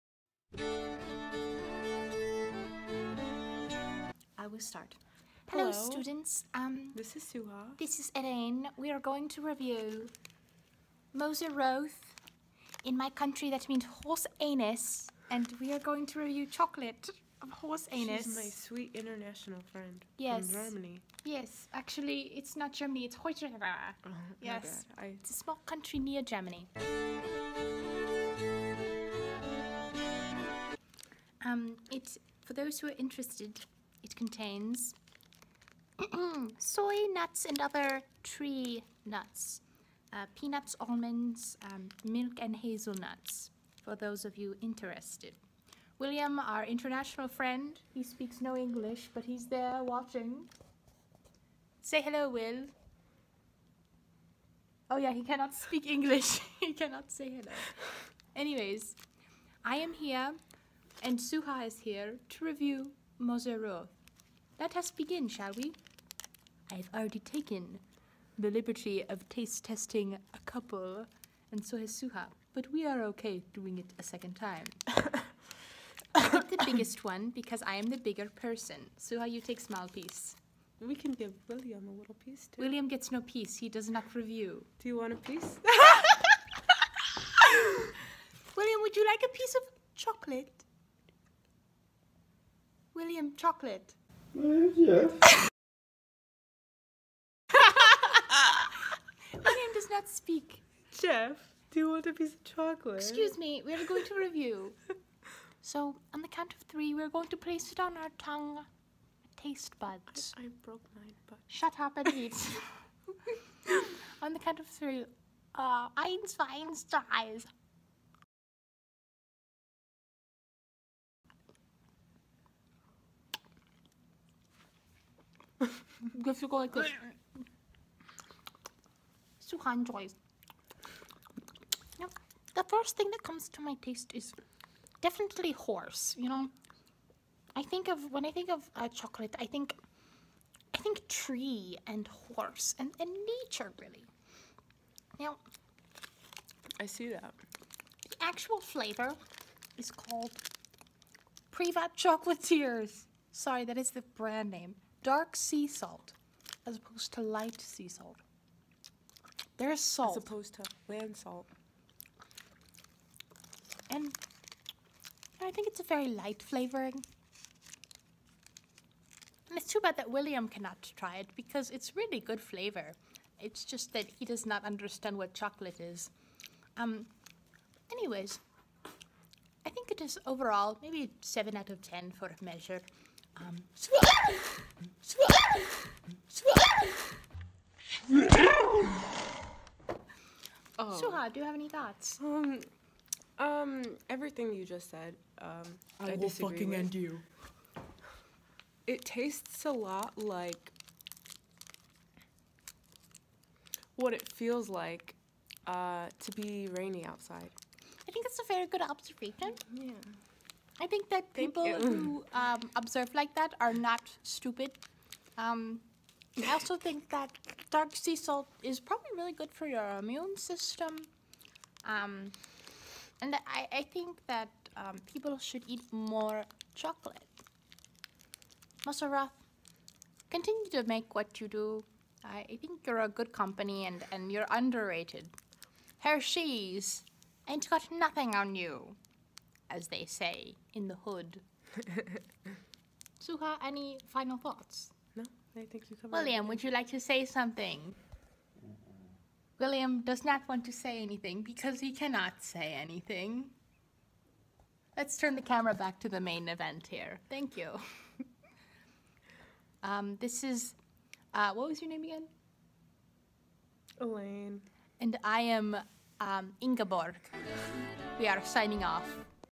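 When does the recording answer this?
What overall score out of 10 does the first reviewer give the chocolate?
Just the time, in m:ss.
3:01.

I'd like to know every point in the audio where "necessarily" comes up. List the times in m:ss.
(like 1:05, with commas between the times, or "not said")
not said.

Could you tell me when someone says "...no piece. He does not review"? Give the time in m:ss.
1:23.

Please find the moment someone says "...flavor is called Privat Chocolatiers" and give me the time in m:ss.
2:28.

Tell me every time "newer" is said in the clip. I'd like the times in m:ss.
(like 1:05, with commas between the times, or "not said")
not said.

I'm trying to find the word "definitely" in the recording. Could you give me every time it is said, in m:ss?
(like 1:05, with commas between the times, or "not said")
2:15.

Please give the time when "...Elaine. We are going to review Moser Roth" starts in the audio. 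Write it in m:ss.
0:08.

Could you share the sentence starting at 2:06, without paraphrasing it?
If you go like this, Suhan joys.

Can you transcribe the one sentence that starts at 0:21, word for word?
Yes, actually, it's not Germany, it's Deutschland.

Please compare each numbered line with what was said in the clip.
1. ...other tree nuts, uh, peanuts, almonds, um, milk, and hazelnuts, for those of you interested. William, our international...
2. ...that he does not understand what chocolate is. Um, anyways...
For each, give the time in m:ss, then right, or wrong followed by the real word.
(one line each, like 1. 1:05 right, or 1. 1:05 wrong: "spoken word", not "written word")
1. 0:37 right
2. 2:53 right.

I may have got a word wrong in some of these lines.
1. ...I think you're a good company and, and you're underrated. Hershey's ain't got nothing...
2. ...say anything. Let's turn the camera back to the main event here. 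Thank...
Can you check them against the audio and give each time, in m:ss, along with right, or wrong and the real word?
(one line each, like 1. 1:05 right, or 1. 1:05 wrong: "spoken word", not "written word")
1. 3:52 right
2. 4:12 right.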